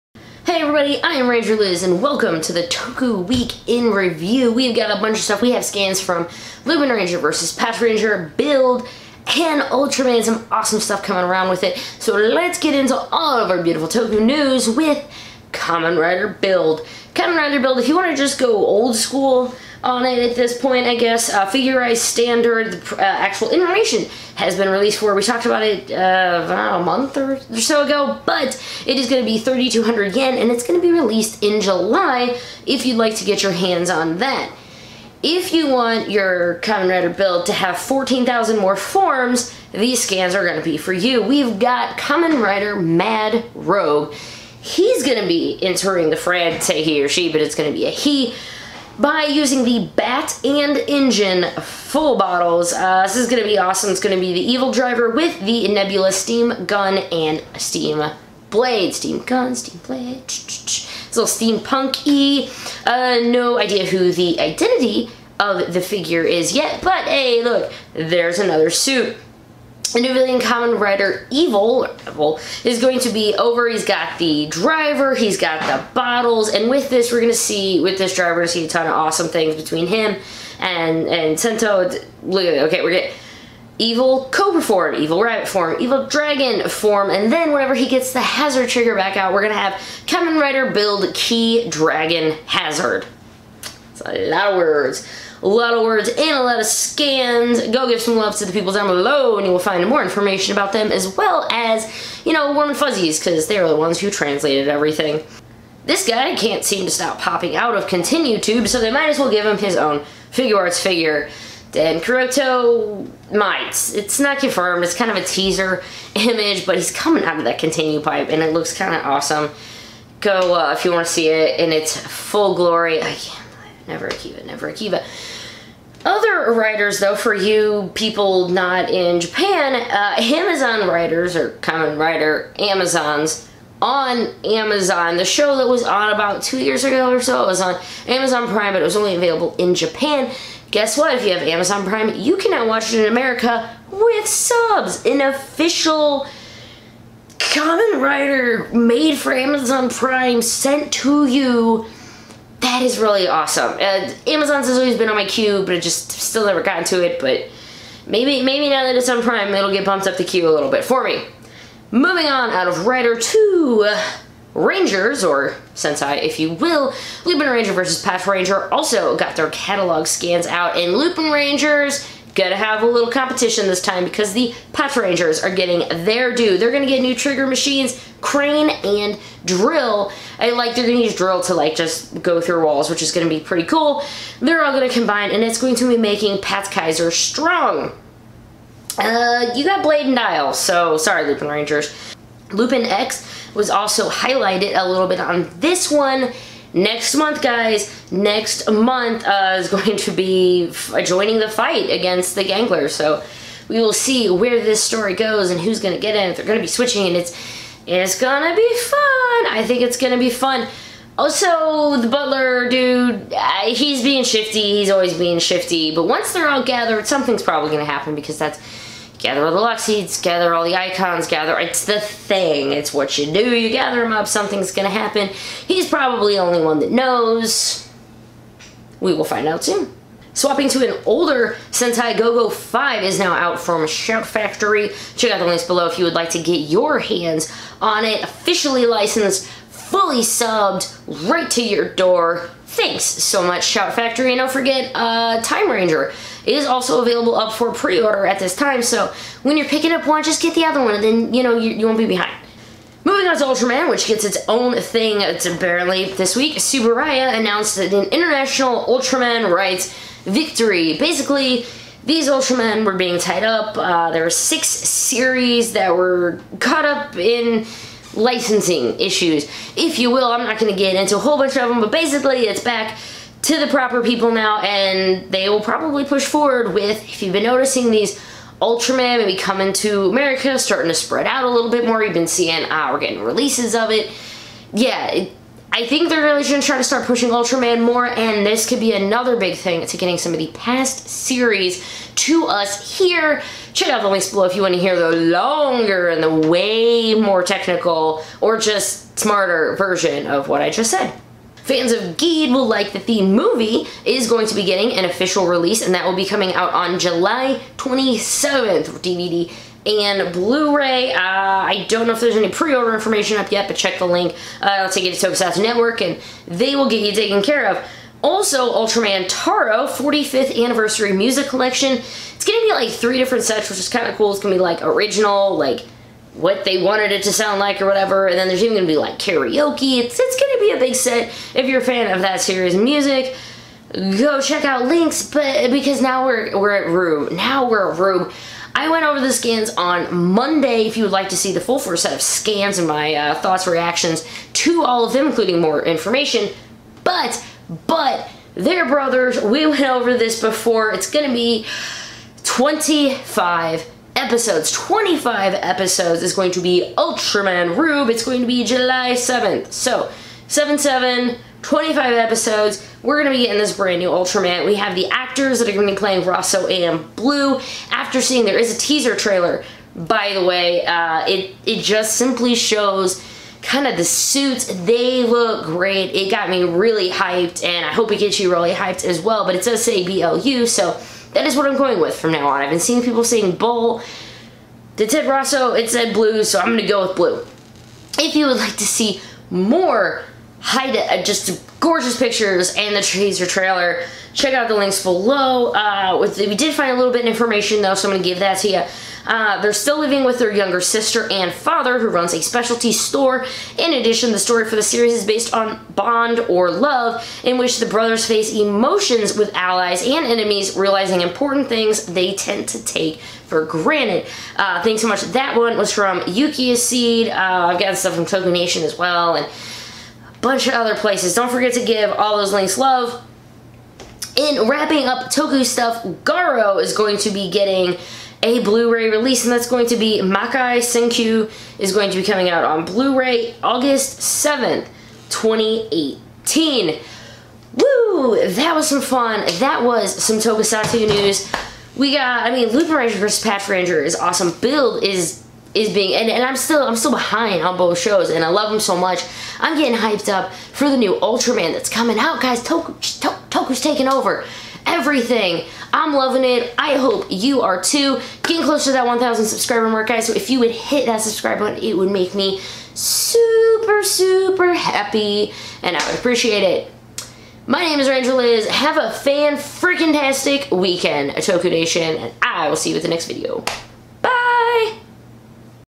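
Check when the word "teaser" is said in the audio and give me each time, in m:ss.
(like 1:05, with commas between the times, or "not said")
1:55, 6:08, 6:33.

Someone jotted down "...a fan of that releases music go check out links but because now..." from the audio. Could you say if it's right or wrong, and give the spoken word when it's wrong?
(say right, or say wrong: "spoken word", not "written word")
wrong: "series", not "releases".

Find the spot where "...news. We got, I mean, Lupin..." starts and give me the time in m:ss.
7:21.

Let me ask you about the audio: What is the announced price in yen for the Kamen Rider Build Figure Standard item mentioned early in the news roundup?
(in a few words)
3,200 yen.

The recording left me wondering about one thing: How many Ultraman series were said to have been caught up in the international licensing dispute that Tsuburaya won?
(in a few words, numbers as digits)
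6.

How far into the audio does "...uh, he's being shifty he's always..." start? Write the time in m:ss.
3:33.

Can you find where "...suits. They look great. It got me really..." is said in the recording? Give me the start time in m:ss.
6:14.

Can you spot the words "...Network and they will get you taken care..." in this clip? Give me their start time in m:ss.
5:15.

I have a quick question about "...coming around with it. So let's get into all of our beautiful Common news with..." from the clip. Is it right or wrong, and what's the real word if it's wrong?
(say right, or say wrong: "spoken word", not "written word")
wrong: "Toku", not "Common".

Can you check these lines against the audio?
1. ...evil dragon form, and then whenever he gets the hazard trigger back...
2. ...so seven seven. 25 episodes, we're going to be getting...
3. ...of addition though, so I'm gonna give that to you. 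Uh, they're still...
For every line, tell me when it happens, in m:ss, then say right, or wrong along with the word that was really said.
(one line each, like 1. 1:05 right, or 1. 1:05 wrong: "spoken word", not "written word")
1. 1:25 right
2. 5:59 right
3. 6:37 wrong: "information", not "addition".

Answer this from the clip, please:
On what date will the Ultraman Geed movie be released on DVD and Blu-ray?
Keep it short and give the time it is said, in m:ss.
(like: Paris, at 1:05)
July 27th, at 5:06.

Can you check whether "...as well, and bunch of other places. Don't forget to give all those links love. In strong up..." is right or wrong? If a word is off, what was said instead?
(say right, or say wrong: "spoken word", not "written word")
wrong: "wrapping", not "strong".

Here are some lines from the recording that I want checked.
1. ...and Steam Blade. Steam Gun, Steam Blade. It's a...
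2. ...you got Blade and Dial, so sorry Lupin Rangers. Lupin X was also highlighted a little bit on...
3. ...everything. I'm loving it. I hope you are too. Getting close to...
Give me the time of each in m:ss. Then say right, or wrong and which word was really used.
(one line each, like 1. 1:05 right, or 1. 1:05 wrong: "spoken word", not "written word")
1. 0:57 right
2. 3:09 right
3. 7:34 right.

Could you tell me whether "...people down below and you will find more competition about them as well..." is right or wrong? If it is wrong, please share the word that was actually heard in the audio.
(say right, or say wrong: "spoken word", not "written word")
wrong: "information", not "competition".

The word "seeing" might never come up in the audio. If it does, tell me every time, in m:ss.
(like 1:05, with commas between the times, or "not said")
4:42, 6:08, 6:22.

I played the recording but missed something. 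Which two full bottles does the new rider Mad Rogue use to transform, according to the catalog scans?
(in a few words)
Bat and Engine.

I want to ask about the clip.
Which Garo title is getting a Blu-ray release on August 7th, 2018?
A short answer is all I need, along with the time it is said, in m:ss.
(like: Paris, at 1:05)
Makai Senki, at 7:10.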